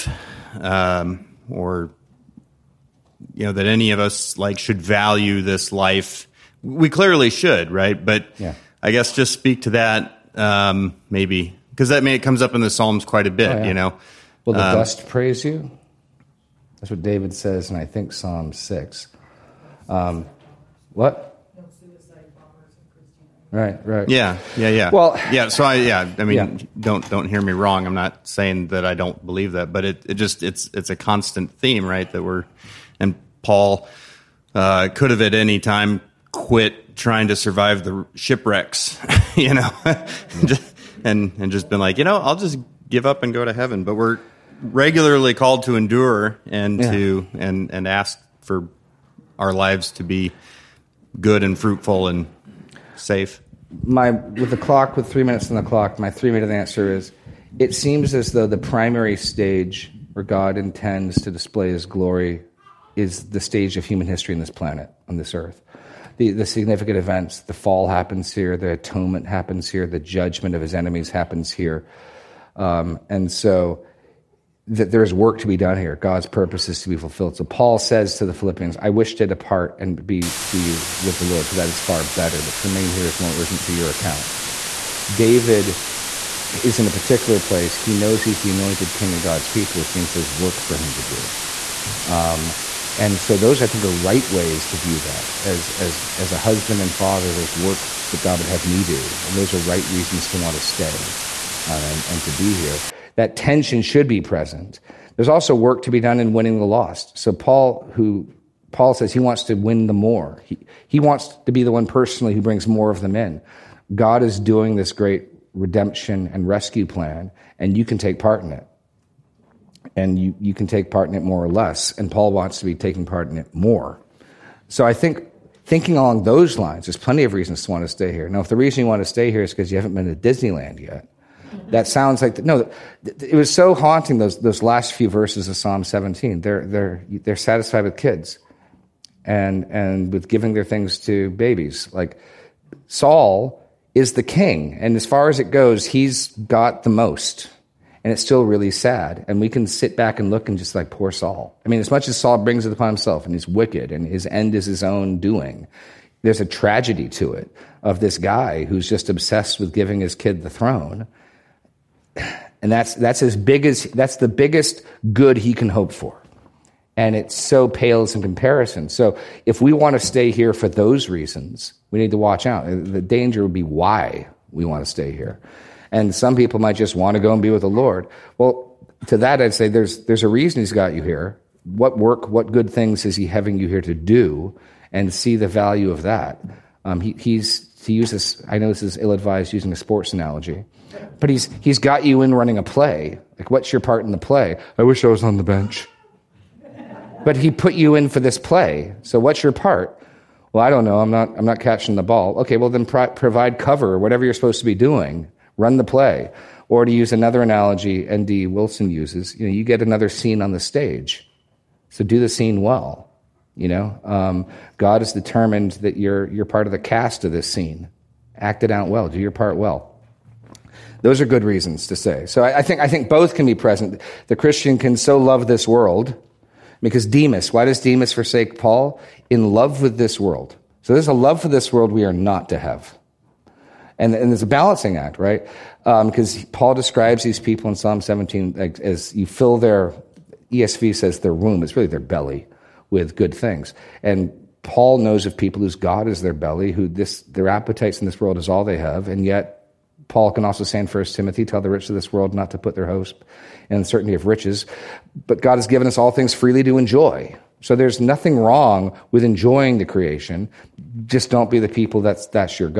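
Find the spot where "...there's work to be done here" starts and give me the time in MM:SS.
01:14.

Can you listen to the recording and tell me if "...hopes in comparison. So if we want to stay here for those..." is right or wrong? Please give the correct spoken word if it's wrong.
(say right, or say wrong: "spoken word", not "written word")
wrong: "pales", not "hopes".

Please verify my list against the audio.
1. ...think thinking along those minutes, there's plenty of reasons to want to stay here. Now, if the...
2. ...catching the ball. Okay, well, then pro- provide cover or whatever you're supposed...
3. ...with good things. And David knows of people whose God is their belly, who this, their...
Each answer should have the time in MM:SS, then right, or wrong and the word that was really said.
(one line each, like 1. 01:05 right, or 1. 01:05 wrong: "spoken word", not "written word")
1. 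02:04 wrong: "lines", not "minutes"
2. 03:21 right
3. 04:02 wrong: "Paul", not "David".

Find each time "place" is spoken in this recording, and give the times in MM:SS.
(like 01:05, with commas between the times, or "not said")
01:27.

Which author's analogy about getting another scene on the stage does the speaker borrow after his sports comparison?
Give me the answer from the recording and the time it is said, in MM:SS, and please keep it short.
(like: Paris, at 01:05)
N.D. Wilson, at 03:28.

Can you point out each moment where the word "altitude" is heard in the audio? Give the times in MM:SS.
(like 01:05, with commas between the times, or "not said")
not said.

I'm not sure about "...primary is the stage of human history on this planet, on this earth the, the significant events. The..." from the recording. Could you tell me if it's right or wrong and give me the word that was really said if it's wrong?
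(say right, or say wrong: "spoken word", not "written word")
wrong: "glory", not "primary".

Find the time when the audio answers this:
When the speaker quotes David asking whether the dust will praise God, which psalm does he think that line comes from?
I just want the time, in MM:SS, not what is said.
00:18.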